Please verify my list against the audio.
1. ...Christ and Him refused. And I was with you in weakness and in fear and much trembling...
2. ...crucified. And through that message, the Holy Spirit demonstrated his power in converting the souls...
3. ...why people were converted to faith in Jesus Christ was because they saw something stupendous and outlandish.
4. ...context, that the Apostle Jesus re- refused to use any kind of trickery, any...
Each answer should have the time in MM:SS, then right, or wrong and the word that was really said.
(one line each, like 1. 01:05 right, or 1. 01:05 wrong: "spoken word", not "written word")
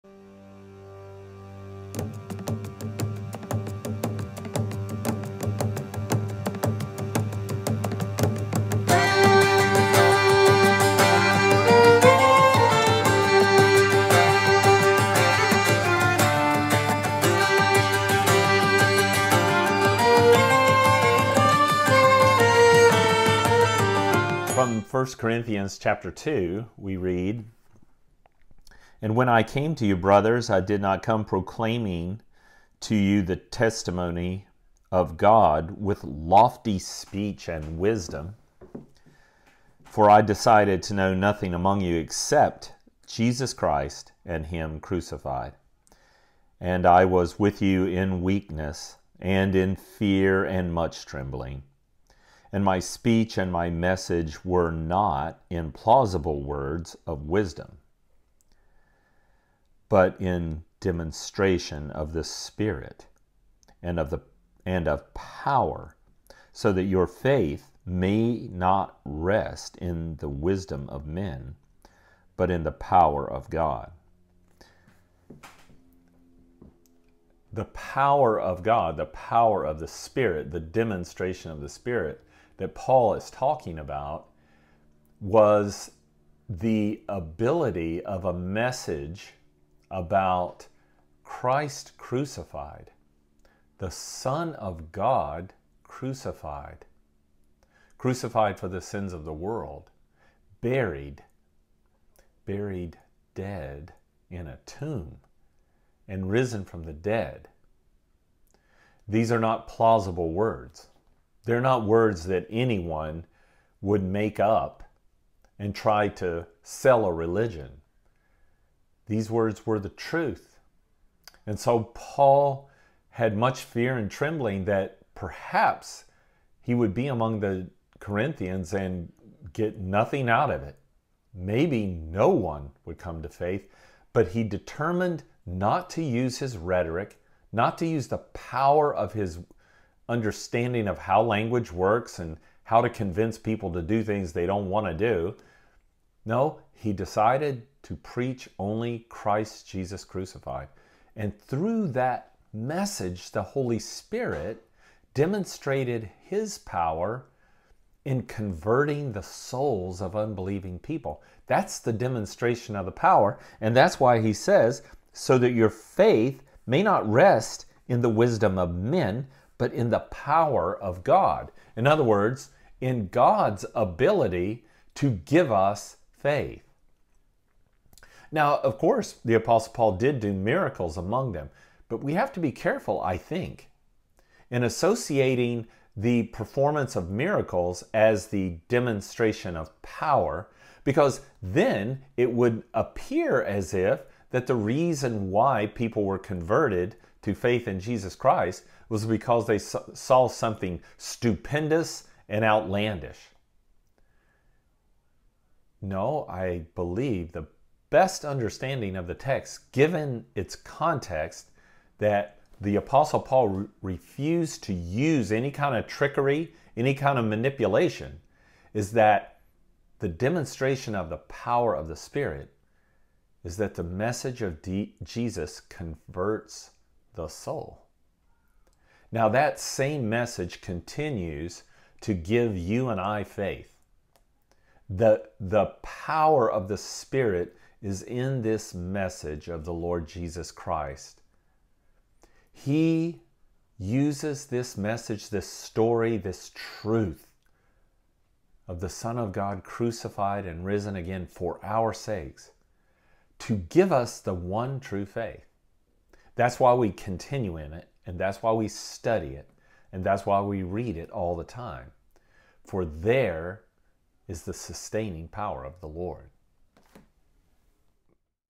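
1. 00:43 wrong: "crucified", not "refused"
2. 02:30 right
3. 03:15 right
4. 03:30 wrong: "Paul", not "Jesus".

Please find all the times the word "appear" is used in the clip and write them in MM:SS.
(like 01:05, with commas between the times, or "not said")
03:12.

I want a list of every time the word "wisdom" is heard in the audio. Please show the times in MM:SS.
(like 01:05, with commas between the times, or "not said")
00:37, 00:57, 01:10, 02:48.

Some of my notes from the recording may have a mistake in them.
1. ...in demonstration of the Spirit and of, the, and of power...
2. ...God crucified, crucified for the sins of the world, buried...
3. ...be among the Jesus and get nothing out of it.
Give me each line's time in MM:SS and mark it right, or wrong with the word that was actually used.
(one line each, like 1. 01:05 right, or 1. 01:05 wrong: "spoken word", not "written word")
1. 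01:00 right
2. 01:34 right
3. 02:06 wrong: "Corinthians", not "Jesus".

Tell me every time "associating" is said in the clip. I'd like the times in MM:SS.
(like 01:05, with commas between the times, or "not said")
03:04.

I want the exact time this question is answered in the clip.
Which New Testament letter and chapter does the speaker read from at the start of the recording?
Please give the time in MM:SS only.
00:24.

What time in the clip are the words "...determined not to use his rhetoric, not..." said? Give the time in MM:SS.
02:14.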